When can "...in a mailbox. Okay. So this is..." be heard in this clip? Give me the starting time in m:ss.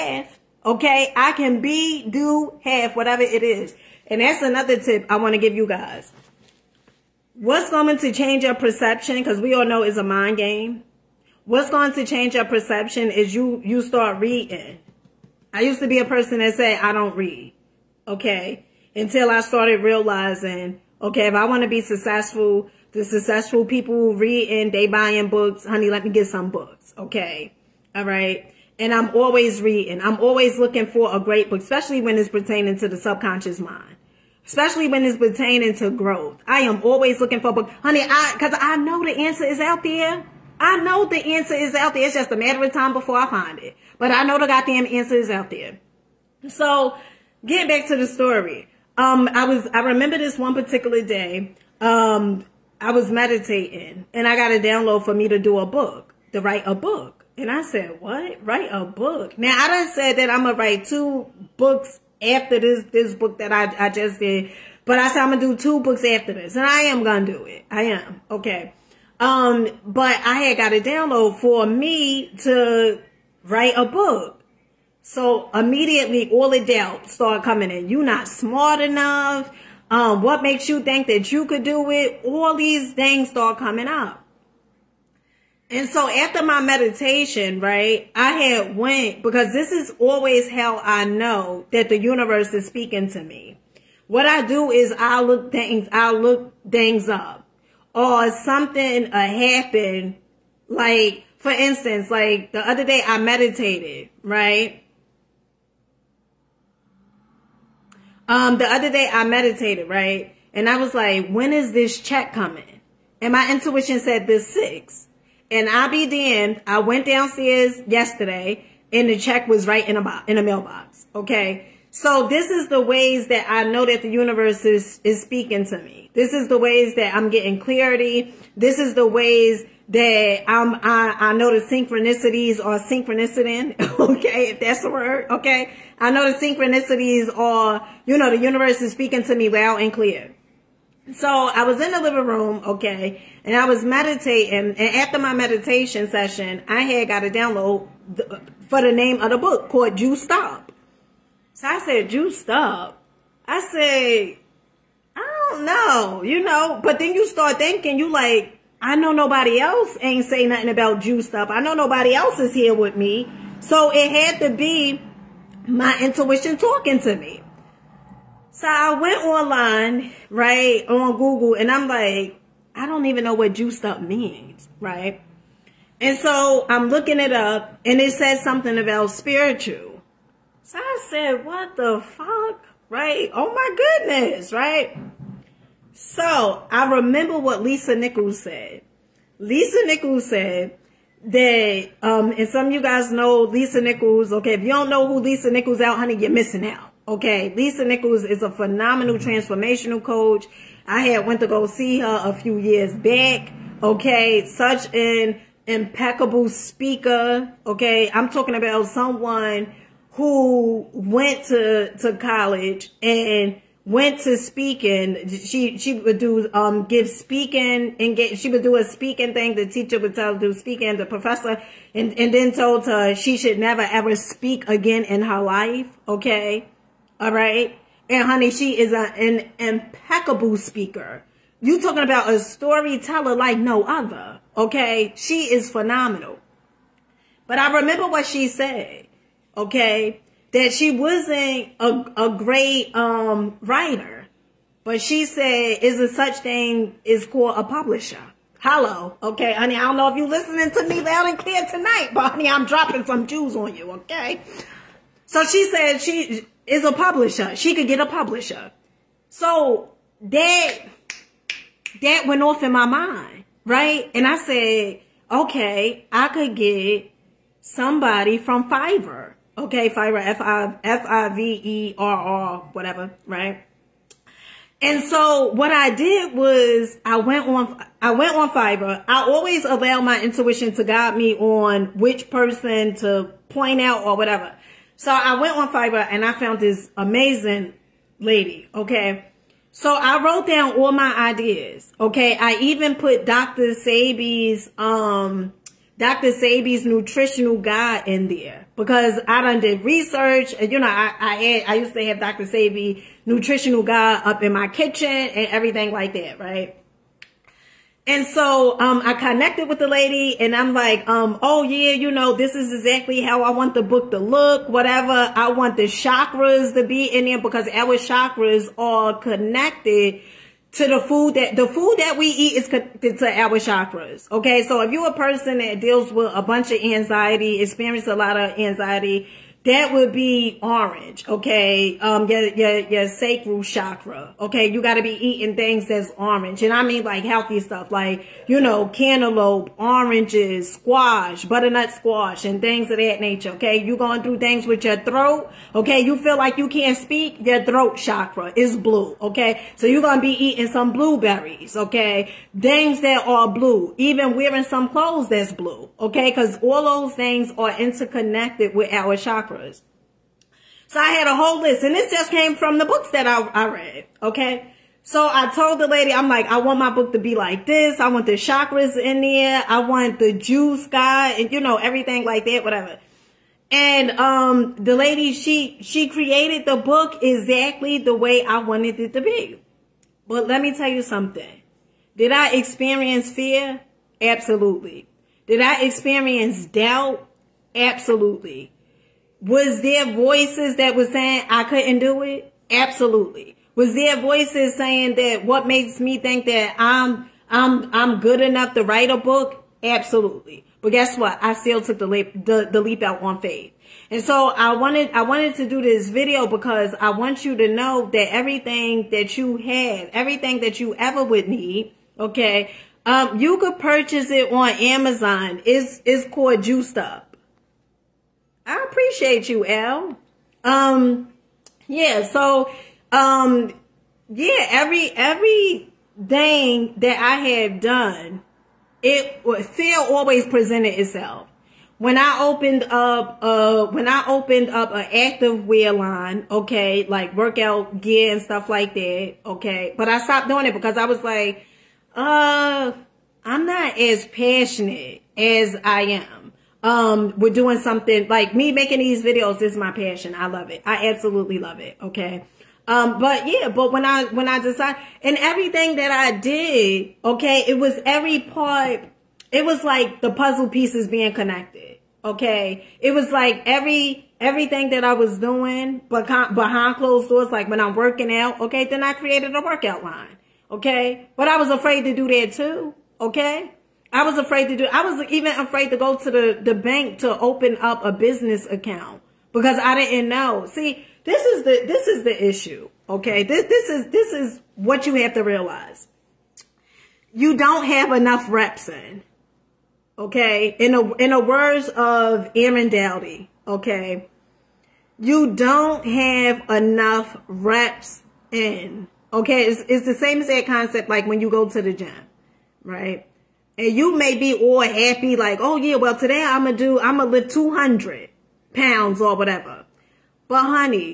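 2:00.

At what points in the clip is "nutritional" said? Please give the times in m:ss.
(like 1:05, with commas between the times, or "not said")
4:56, 5:03.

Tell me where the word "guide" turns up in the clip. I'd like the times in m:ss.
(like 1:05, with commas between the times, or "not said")
4:40, 4:57, 5:03.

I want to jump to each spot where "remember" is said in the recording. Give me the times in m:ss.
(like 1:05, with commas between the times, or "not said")
0:49, 3:06, 3:57.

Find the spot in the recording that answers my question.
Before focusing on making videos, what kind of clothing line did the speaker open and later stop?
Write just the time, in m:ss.
7:15.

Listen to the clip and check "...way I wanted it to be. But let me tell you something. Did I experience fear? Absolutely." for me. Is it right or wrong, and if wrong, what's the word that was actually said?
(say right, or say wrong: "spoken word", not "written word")
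right.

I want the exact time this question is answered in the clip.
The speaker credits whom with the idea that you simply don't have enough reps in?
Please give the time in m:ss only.
8:12.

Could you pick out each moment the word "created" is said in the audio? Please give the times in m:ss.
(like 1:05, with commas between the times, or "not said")
6:16, 7:49.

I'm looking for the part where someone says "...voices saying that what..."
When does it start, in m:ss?
6:34.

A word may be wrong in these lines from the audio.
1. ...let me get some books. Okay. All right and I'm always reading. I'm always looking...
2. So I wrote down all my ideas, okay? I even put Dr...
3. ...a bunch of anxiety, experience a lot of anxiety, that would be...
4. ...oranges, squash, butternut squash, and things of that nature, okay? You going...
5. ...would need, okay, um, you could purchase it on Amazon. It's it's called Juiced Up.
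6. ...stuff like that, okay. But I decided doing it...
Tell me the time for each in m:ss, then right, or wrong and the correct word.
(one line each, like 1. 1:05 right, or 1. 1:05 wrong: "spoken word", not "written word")
1. 0:25 right
2. 4:49 right
3. 5:26 right
4. 5:39 right
5. 6:51 right
6. 7:18 wrong: "stopped", not "decided".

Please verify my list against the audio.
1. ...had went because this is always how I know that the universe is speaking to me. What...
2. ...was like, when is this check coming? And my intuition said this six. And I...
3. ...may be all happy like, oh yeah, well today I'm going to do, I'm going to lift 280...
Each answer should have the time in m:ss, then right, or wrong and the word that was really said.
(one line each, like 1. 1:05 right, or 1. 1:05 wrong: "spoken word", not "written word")
1. 1:28 right
2. 1:50 right
3. 8:24 wrong: "200", not "280".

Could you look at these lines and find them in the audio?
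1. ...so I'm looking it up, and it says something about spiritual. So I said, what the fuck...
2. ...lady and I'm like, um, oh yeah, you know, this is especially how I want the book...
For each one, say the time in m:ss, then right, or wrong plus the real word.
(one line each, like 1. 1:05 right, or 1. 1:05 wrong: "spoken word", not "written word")
1. 2:56 right
2. 5:09 wrong: "exactly", not "especially".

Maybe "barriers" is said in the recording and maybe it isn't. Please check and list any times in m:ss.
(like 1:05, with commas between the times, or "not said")
not said.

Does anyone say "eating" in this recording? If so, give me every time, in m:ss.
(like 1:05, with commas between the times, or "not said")
5:35, 5:50.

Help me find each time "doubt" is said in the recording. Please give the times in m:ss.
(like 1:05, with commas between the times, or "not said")
1:16, 6:26.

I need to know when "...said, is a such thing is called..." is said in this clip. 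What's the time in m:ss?
4:05.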